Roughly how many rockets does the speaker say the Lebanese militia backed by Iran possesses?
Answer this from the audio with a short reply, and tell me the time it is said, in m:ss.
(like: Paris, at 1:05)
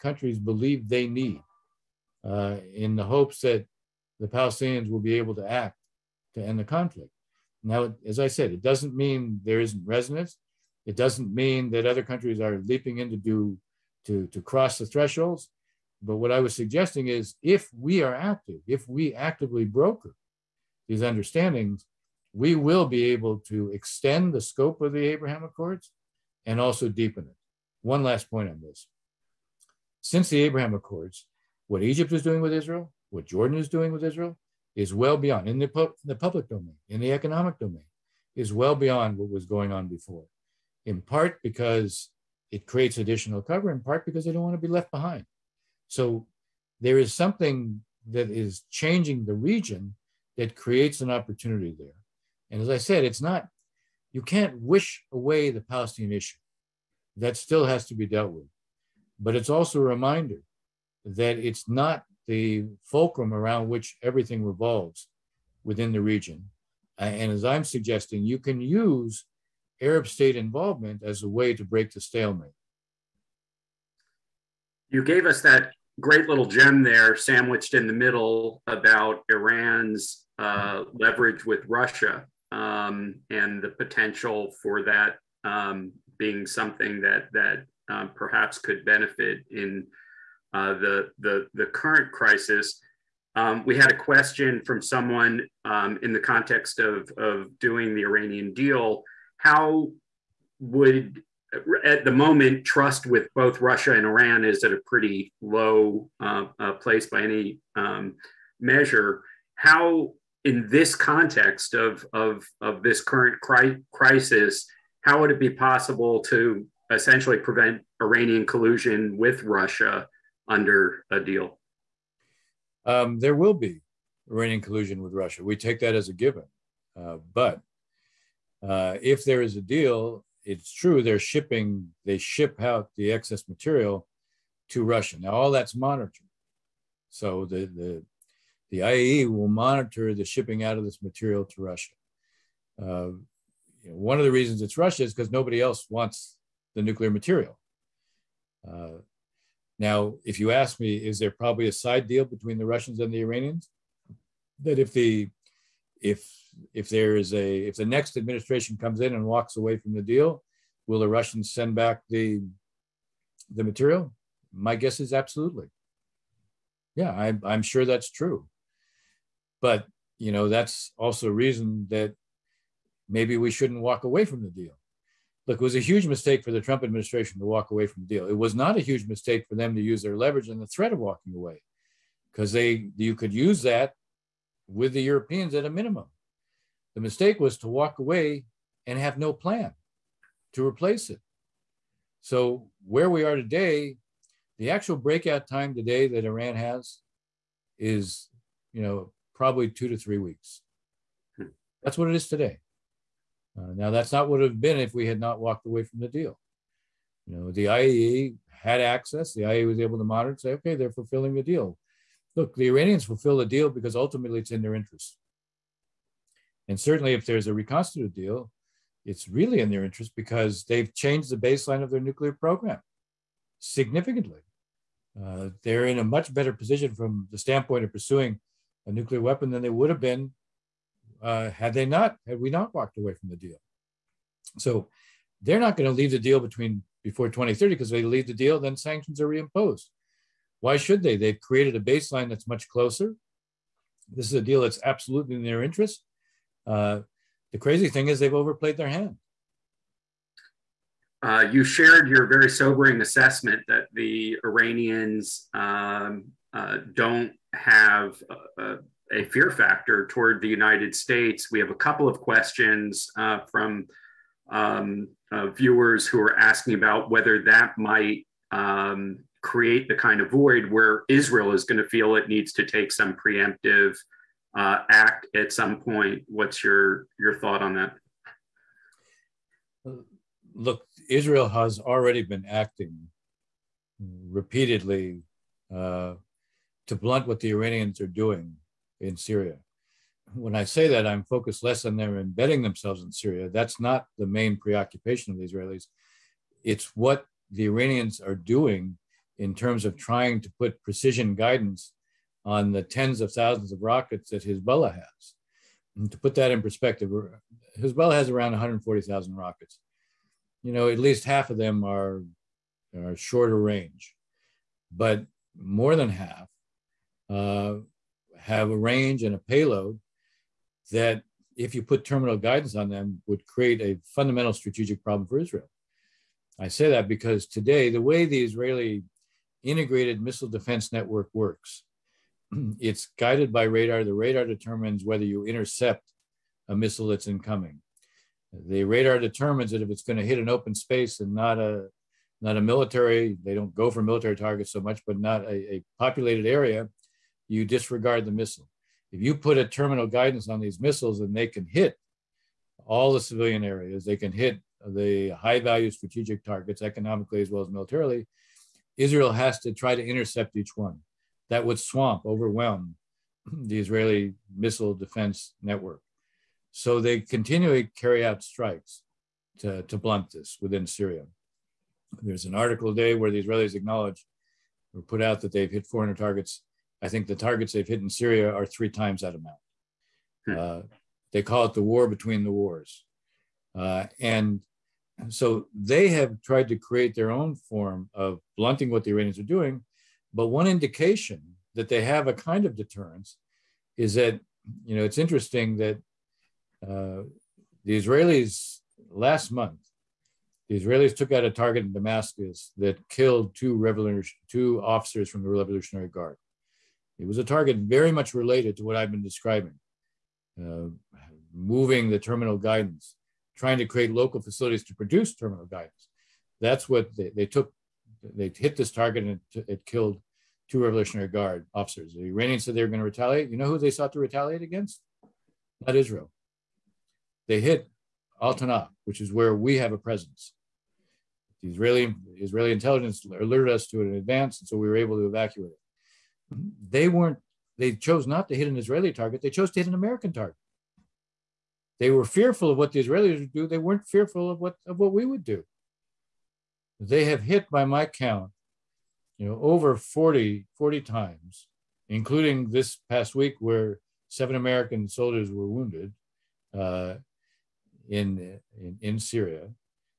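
140,000, at 5:08.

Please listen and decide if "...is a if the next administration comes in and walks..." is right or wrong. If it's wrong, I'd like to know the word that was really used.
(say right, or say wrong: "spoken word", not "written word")
right.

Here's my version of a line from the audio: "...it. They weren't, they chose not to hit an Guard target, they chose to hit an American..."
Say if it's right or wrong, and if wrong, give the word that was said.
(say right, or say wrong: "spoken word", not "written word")
wrong: "Israeli", not "Guard".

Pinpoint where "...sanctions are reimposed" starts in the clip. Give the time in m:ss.
3:58.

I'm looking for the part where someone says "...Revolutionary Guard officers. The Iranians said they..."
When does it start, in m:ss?
7:00.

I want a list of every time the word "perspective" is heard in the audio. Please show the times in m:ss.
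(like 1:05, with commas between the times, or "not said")
5:06.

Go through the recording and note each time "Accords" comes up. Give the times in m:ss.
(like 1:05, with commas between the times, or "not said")
0:25, 0:30.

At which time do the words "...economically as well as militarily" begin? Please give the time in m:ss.
5:56.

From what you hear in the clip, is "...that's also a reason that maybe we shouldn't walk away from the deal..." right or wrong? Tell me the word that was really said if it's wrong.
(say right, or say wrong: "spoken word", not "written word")
right.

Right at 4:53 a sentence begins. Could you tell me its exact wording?
That's not the main preoccupation of the Israelis.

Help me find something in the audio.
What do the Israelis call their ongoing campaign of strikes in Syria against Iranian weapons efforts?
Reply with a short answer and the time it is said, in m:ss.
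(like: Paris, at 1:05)
the war between the wars, at 6:21.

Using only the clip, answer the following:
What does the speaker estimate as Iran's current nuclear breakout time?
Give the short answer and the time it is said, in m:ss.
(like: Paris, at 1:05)
2 to 3 weeks, at 3:19.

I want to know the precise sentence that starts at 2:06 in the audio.
Uh, but uh, if there is a deal, it's true they're shipping, they ship out the excess material to Russia.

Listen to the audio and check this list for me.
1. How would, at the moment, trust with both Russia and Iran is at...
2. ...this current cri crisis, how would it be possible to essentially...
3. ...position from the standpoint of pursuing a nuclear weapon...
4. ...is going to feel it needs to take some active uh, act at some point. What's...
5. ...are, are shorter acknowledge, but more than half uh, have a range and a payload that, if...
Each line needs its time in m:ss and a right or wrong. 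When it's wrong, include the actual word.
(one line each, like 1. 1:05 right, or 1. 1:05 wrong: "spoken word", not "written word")
1. 1:39 right
2. 1:52 right
3. 3:46 right
4. 4:31 wrong: "preemptive", not "active"
5. 5:11 wrong: "range", not "acknowledge".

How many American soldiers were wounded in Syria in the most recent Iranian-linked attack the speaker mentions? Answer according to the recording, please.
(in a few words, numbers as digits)
7.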